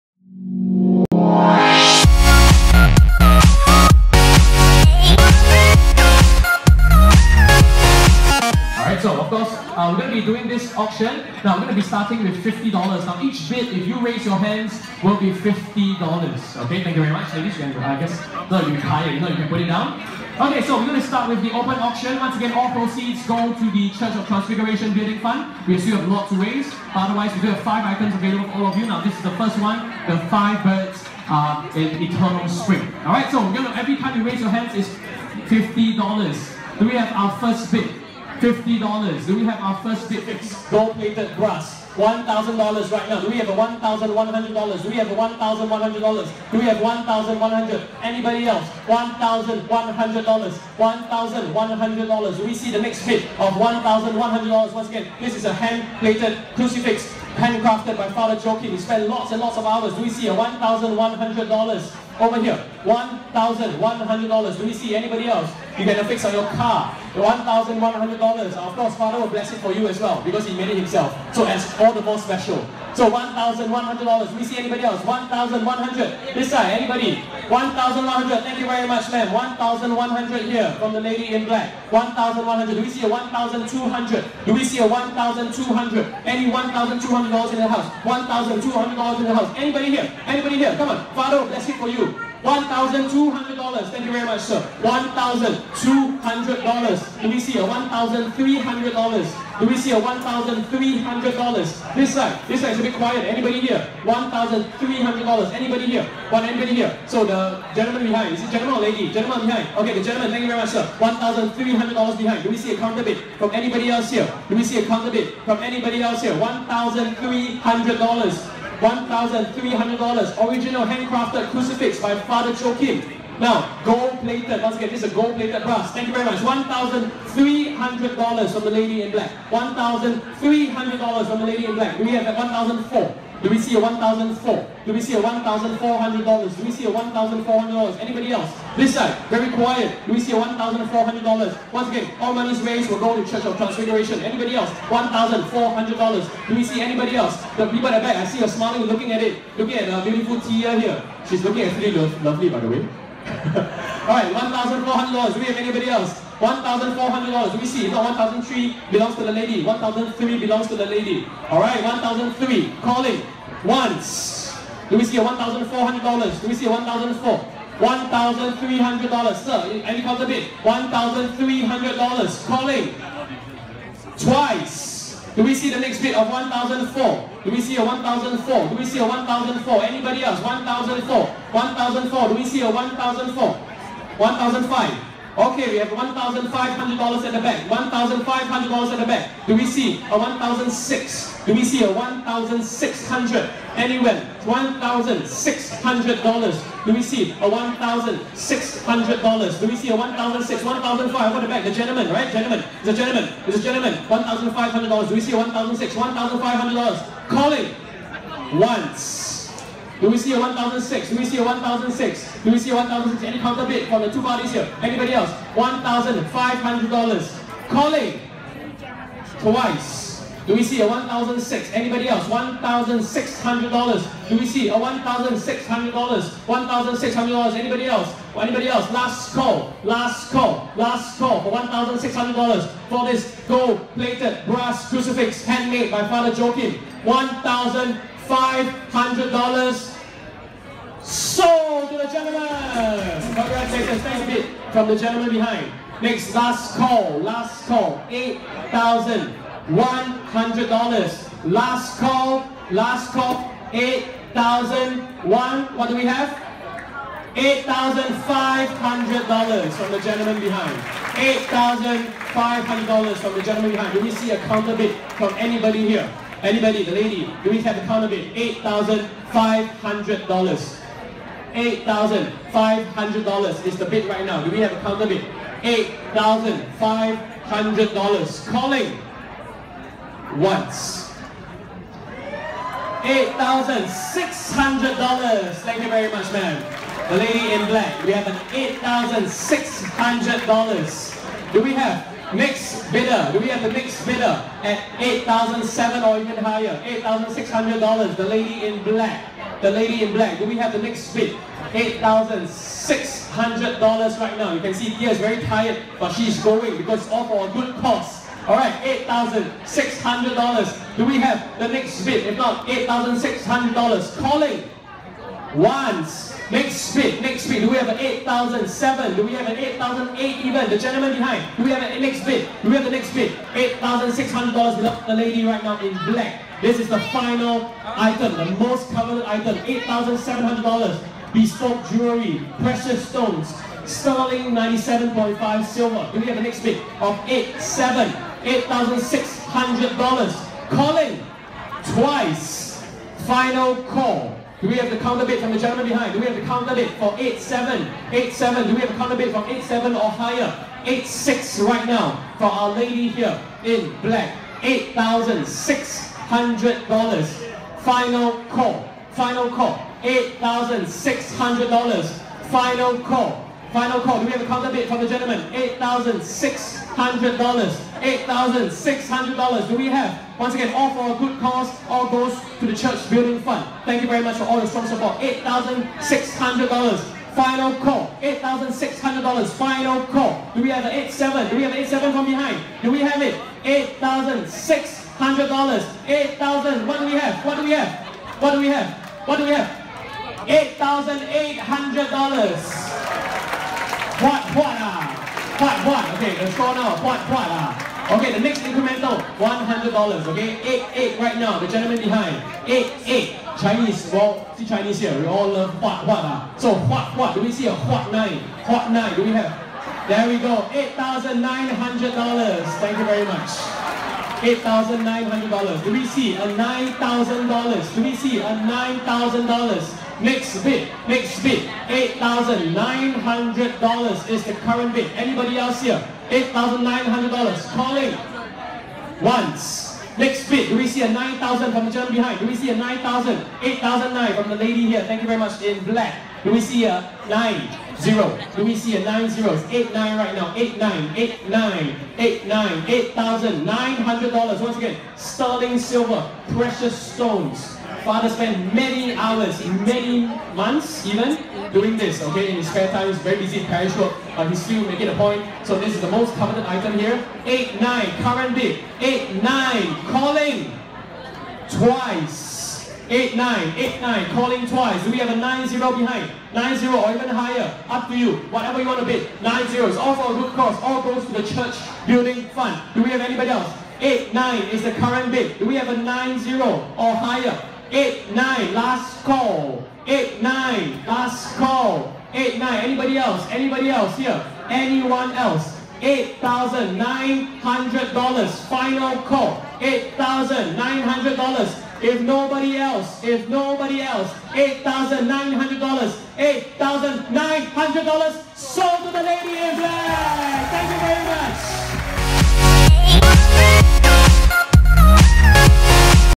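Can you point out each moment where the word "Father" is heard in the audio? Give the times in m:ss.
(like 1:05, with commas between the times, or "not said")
1:08, 1:31, 2:02, 3:56, 7:28.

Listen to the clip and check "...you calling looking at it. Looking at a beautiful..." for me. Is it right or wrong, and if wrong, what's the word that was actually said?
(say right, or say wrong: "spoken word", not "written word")
wrong: "smiling", not "calling".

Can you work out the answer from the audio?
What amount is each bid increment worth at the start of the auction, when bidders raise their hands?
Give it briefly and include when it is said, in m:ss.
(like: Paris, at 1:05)
$50, at 0:13.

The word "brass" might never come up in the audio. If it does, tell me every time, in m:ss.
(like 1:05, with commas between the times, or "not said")
2:05, 3:54.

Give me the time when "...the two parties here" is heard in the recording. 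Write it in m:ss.
3:34.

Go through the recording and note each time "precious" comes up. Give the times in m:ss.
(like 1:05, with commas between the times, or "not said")
5:32, 7:26.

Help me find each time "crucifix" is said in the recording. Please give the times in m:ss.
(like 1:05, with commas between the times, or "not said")
2:01, 3:54.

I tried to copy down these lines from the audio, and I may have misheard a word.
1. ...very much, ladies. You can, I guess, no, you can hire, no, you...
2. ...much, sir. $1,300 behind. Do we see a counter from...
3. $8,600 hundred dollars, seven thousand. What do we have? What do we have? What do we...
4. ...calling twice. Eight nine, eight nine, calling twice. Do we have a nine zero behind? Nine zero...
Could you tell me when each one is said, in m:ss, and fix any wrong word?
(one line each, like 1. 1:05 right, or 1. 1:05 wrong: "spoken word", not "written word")
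1. 0:17 right
2. 1:50 right
3. 6:23 wrong: "eight", not "seven"
4. 7:40 right.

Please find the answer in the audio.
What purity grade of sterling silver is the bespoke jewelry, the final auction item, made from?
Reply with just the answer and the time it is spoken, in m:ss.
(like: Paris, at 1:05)
97.5, at 5:33.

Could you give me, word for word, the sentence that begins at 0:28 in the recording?
Now, this is the first one, the five birds uh, in Eternal Spring.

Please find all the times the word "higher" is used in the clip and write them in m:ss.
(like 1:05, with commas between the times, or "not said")
4:56, 5:50, 7:47, 7:57.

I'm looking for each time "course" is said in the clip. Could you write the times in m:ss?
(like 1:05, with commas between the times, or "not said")
1:08.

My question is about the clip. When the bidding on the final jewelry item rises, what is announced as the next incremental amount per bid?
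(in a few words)
$100.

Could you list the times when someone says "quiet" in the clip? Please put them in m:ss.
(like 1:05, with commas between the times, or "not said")
1:42, 2:19.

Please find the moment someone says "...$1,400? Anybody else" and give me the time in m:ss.
2:16.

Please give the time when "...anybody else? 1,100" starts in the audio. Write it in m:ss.
1:14.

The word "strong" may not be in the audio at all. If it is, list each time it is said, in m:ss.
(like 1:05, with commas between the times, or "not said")
6:14.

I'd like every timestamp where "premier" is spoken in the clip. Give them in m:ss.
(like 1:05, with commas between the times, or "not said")
not said.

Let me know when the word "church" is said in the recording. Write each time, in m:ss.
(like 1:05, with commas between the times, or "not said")
0:23, 2:23, 6:12, 7:51.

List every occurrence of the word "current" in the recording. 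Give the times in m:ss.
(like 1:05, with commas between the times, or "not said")
7:04, 7:38, 7:54.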